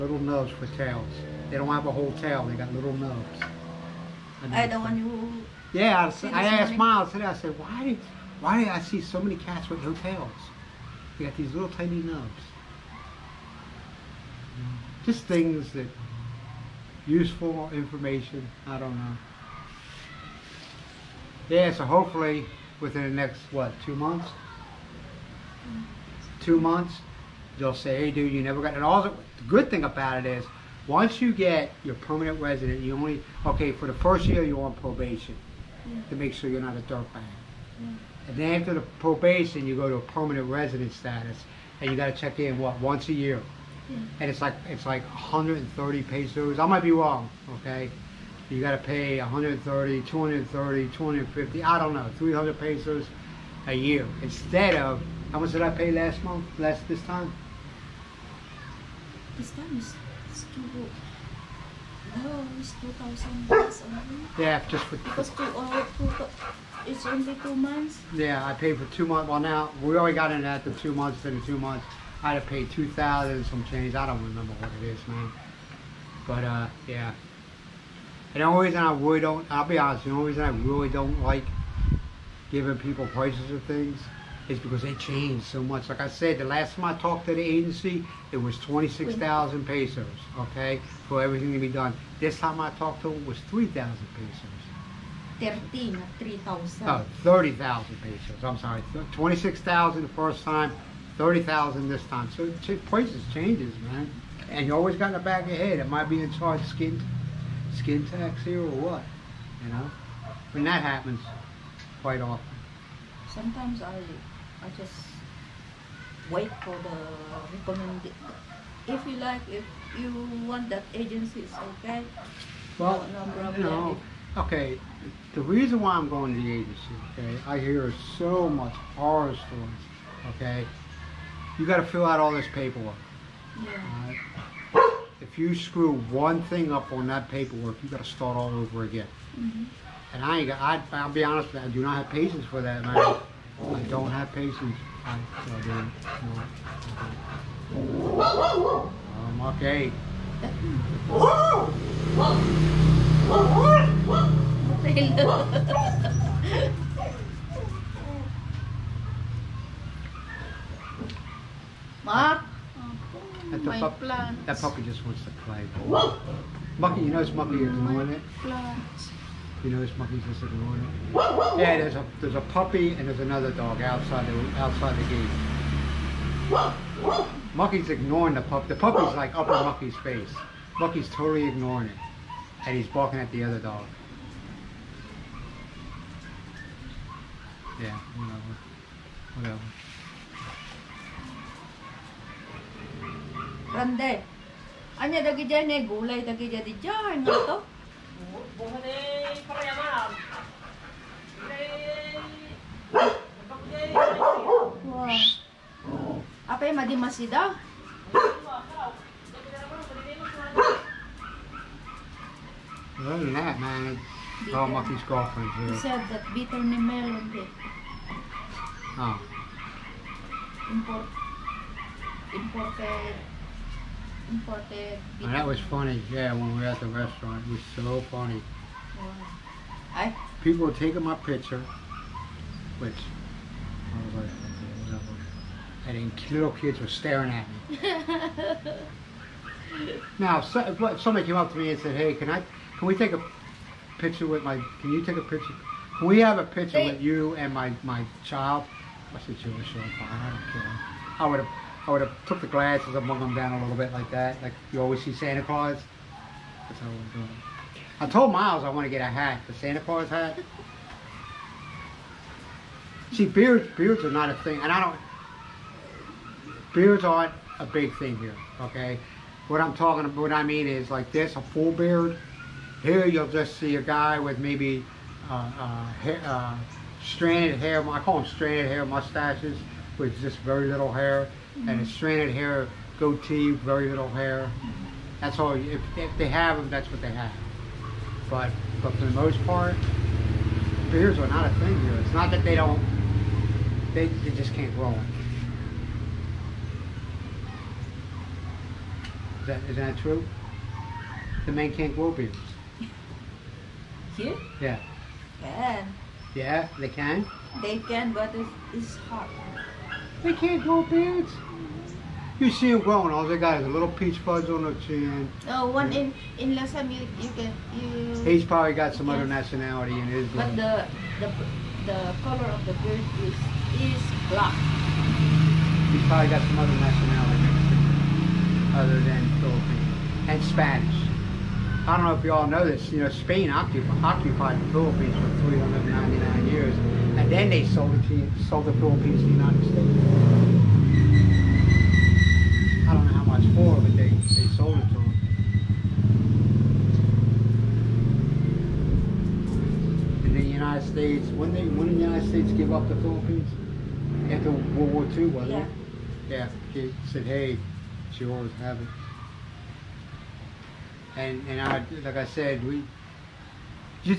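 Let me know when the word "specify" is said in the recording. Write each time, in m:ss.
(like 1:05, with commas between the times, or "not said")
not said.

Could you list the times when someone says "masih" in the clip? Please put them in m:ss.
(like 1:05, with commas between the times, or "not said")
3:26.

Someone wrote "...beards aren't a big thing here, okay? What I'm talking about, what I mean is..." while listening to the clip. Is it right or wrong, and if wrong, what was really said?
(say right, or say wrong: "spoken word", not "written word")
right.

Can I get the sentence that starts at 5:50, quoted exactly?
And the United States, when they when the United States give up the Philippines after World War II, wasn't yeah.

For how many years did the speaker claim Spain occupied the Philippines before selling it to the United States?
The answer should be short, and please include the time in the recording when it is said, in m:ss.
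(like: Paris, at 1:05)
399, at 5:35.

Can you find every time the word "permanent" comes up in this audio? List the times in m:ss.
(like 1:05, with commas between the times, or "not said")
0:31, 0:40.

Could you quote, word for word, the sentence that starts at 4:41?
and a stranded hair goatee, very little hair.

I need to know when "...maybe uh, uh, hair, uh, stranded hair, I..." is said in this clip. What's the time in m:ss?
4:34.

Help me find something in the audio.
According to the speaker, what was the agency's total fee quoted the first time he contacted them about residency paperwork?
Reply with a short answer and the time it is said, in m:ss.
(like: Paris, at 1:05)
26,000 pesos, at 1:28.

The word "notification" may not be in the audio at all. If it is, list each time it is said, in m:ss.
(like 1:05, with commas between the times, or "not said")
not said.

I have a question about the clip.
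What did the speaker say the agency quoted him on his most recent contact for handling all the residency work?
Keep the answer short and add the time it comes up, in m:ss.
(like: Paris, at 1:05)
30,000 pesos, at 1:37.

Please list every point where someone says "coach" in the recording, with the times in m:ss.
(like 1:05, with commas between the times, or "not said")
not said.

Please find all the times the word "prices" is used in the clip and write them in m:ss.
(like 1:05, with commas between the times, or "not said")
1:23, 1:42.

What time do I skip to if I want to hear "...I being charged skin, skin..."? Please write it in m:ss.
1:45.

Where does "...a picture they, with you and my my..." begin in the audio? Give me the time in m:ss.
4:06.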